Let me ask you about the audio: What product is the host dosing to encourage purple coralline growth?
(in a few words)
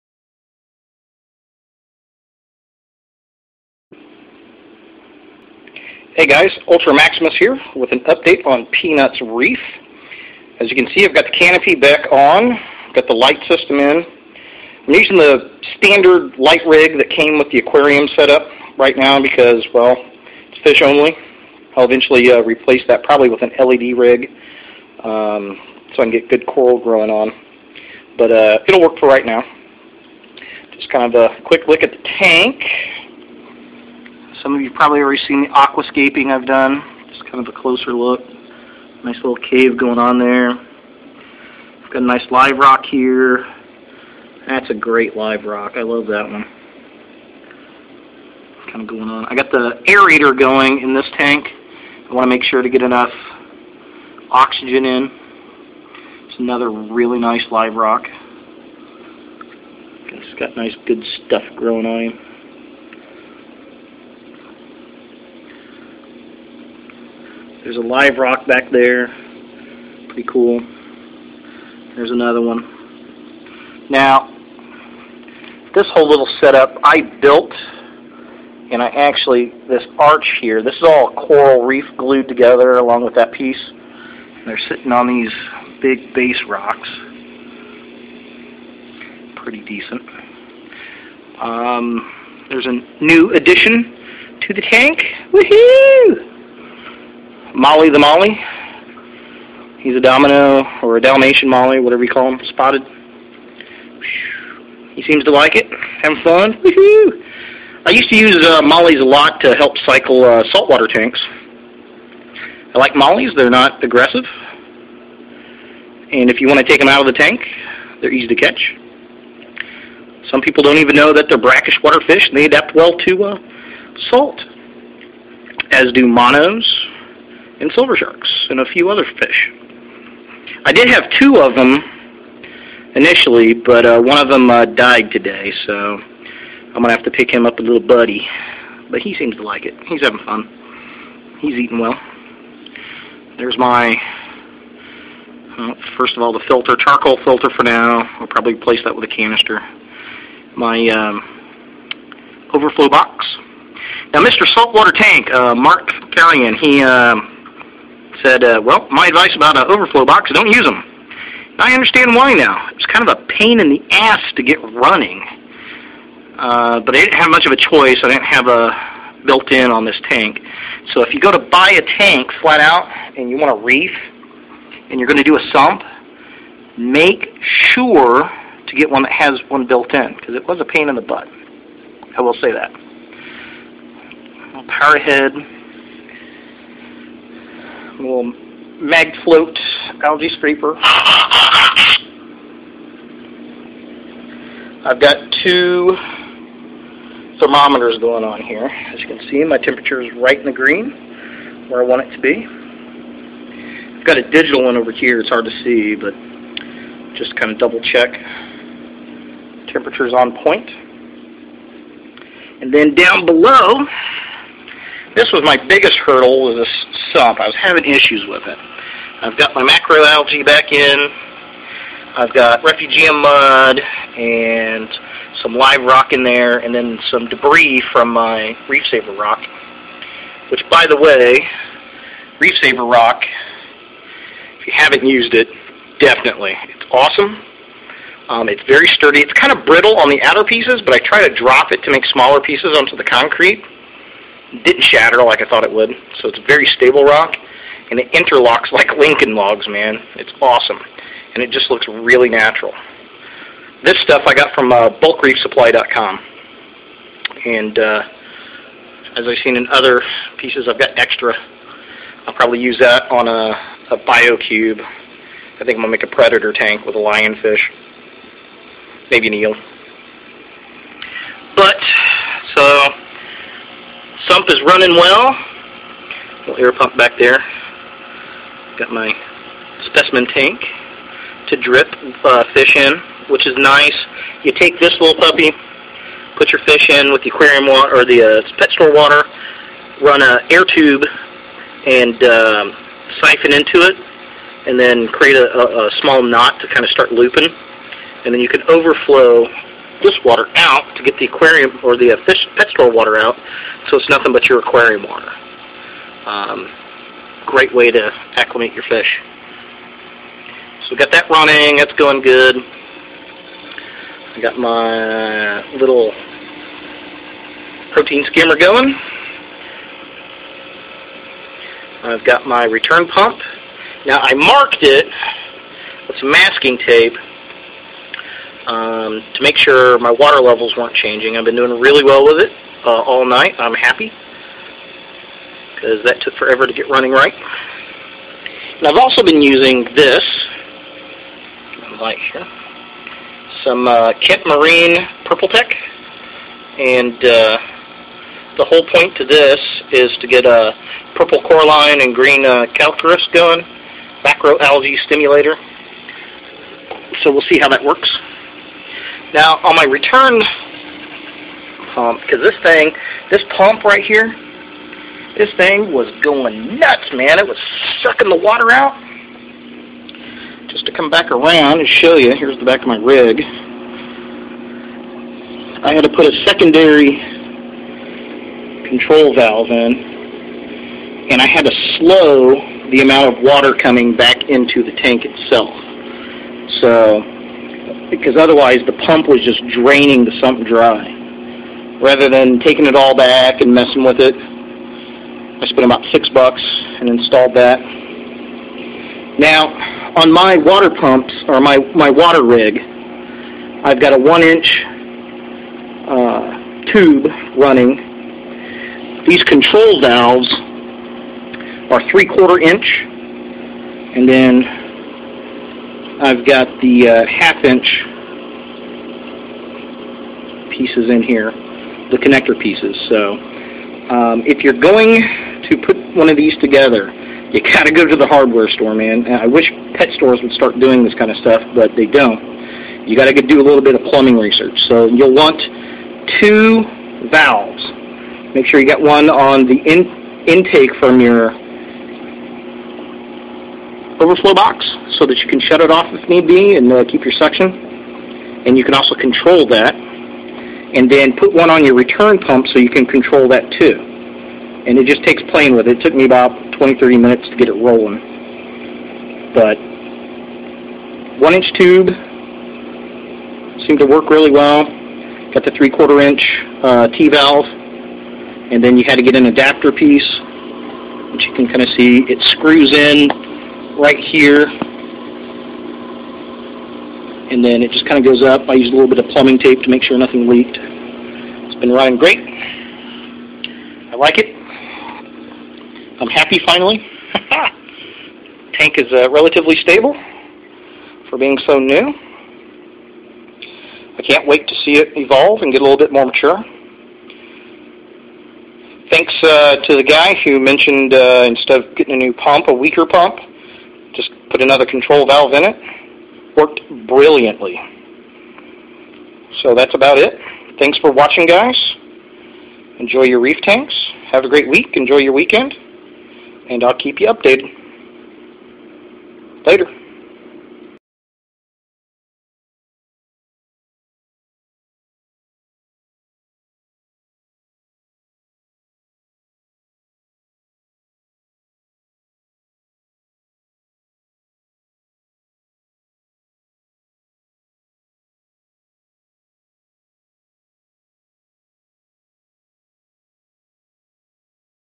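Kent Marine Purple Tech.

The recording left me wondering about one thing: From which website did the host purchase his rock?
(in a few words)
bulkreefsupply.com.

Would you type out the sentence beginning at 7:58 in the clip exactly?
I used a little bit of plumbing tape to make sure nothing leaked.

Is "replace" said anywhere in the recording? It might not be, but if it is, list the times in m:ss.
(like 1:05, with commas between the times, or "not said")
0:22, 2:28.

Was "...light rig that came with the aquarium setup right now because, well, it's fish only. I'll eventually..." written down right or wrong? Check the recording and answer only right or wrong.
right.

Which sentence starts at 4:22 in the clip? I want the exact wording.
I'll probably use that on a, a cube.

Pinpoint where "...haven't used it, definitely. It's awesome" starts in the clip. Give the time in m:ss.
3:54.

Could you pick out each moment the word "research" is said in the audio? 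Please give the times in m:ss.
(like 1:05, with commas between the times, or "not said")
7:14.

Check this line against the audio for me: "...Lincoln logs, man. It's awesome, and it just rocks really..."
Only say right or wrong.
wrong.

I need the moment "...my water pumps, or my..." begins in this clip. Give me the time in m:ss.
6:40.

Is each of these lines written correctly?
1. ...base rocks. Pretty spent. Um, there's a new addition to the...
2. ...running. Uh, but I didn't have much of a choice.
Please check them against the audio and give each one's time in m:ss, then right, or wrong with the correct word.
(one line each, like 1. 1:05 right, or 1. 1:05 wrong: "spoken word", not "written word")
1. 1:26 wrong: "decent", not "spent"
2. 2:44 right.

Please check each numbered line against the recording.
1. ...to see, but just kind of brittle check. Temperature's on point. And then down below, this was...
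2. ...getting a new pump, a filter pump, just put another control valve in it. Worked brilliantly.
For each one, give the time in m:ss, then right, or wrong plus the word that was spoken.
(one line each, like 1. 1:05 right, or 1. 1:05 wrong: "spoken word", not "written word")
1. 3:25 wrong: "double", not "brittle"
2. 8:21 wrong: "weaker", not "filter".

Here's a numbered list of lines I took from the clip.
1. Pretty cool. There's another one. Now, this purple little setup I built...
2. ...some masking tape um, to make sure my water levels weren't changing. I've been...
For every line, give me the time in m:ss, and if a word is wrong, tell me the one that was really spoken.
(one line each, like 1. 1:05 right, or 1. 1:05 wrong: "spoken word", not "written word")
1. 1:10 wrong: "whole", not "purple"
2. 5:26 right.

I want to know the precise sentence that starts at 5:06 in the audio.
Um, great way to acclimate your fish.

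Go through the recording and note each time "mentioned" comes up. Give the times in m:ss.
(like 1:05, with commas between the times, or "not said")
8:20.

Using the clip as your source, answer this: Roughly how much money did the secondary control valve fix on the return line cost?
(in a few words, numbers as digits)
6 dollars.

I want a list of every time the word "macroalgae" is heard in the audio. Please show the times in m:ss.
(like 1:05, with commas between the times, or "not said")
3:39, 5:54.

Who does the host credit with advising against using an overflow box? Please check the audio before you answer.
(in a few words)
Mark Carrion.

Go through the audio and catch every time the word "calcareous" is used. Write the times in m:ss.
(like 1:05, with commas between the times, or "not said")
5:52.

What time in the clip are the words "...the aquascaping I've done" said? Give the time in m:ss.
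0:35.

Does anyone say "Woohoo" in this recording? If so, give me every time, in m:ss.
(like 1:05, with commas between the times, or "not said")
1:35, 1:46.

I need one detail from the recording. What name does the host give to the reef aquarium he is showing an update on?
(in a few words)
P-NUT's Reef.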